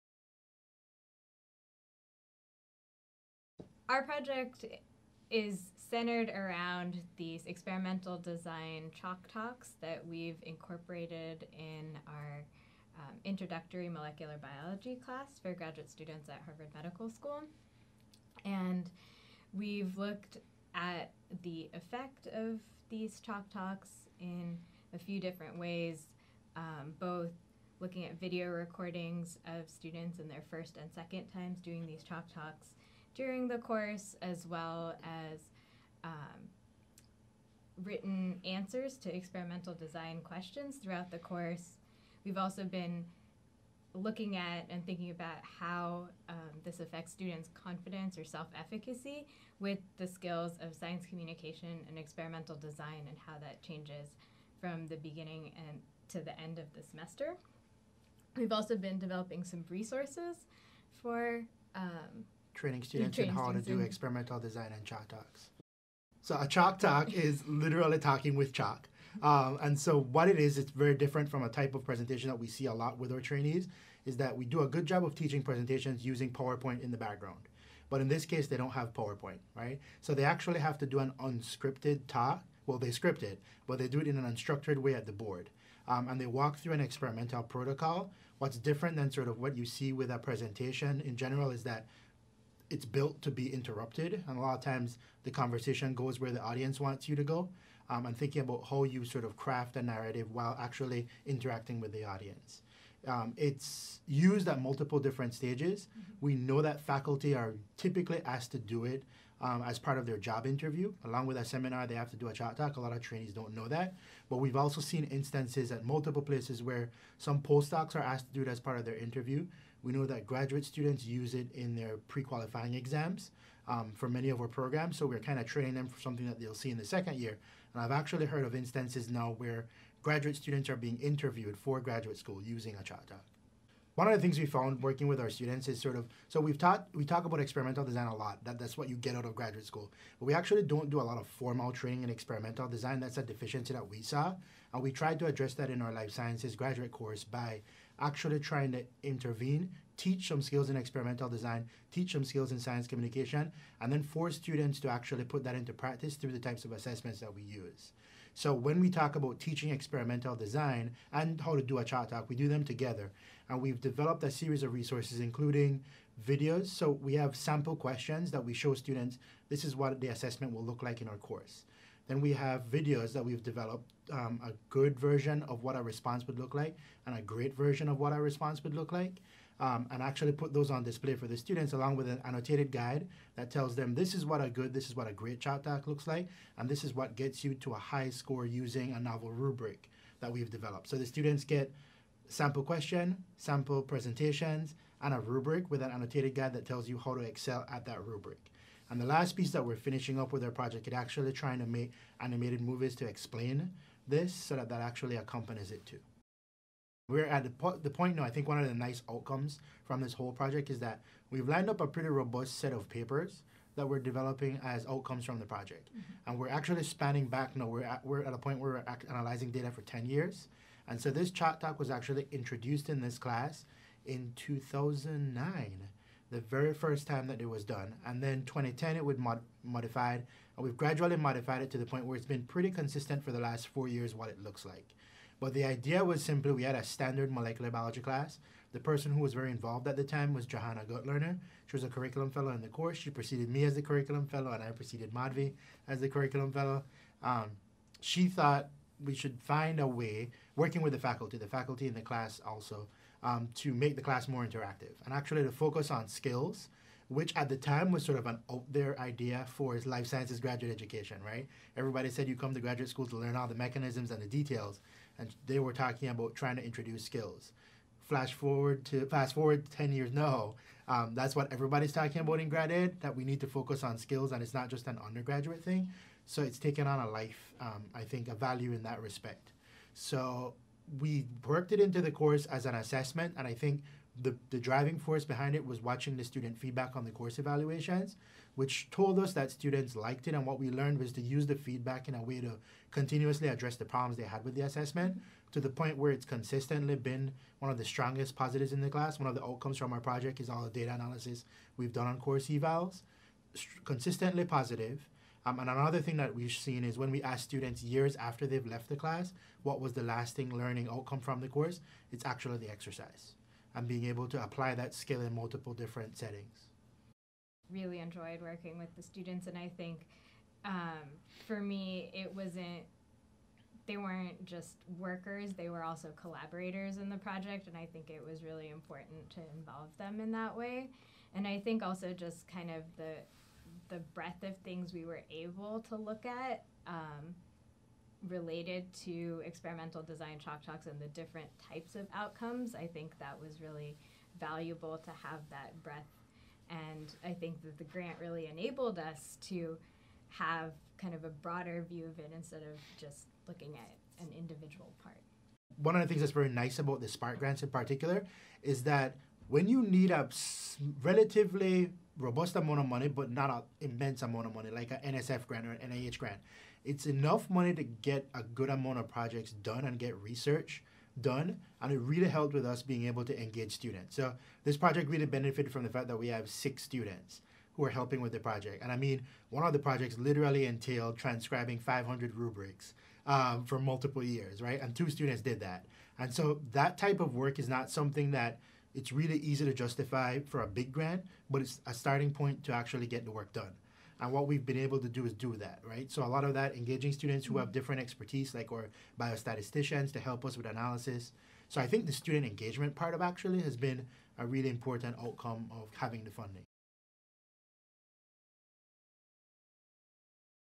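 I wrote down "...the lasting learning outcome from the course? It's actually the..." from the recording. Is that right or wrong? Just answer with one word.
right.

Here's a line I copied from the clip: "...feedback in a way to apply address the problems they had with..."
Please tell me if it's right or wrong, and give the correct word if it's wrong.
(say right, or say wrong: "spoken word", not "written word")
wrong: "continuously", not "apply".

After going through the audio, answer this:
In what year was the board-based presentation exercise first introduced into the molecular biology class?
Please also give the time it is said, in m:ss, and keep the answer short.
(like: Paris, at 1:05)
2009, at 3:44.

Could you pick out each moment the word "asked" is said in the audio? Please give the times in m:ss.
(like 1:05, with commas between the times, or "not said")
1:48, 1:57.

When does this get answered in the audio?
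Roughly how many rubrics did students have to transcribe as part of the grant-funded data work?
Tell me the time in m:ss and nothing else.
6:21.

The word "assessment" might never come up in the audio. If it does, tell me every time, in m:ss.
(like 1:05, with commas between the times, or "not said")
2:36, 2:50, 4:42, 4:54.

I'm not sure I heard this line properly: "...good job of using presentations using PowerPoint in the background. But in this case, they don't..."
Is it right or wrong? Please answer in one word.
wrong.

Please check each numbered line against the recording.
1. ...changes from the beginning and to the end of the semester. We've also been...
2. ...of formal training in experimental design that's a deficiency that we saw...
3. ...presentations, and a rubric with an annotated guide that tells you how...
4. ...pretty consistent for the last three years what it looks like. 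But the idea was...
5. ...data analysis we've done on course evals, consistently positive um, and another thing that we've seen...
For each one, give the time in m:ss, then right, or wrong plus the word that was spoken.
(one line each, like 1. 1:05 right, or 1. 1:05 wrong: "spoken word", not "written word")
1. 0:53 right
2. 2:21 right
3. 3:13 right
4. 3:52 wrong: "four", not "three"
5. 5:00 right.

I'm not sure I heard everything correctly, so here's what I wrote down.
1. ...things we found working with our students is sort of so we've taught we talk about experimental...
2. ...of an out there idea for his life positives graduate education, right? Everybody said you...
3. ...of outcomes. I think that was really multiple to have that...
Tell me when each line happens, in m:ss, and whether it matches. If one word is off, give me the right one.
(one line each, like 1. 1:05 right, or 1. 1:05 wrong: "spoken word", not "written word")
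1. 2:14 right
2. 4:18 wrong: "sciences", not "positives"
3. 5:41 wrong: "valuable", not "multiple".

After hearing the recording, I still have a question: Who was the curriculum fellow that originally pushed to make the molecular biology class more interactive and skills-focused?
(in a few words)
Johanna Gutlerner.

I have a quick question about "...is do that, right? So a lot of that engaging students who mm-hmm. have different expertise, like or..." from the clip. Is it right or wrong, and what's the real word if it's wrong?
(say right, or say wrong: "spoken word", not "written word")
right.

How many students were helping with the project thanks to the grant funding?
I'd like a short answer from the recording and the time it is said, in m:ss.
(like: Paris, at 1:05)
6, at 6:16.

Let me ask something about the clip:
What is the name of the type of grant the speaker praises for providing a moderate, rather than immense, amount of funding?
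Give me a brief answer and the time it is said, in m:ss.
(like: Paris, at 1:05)
Spark grants, at 5:57.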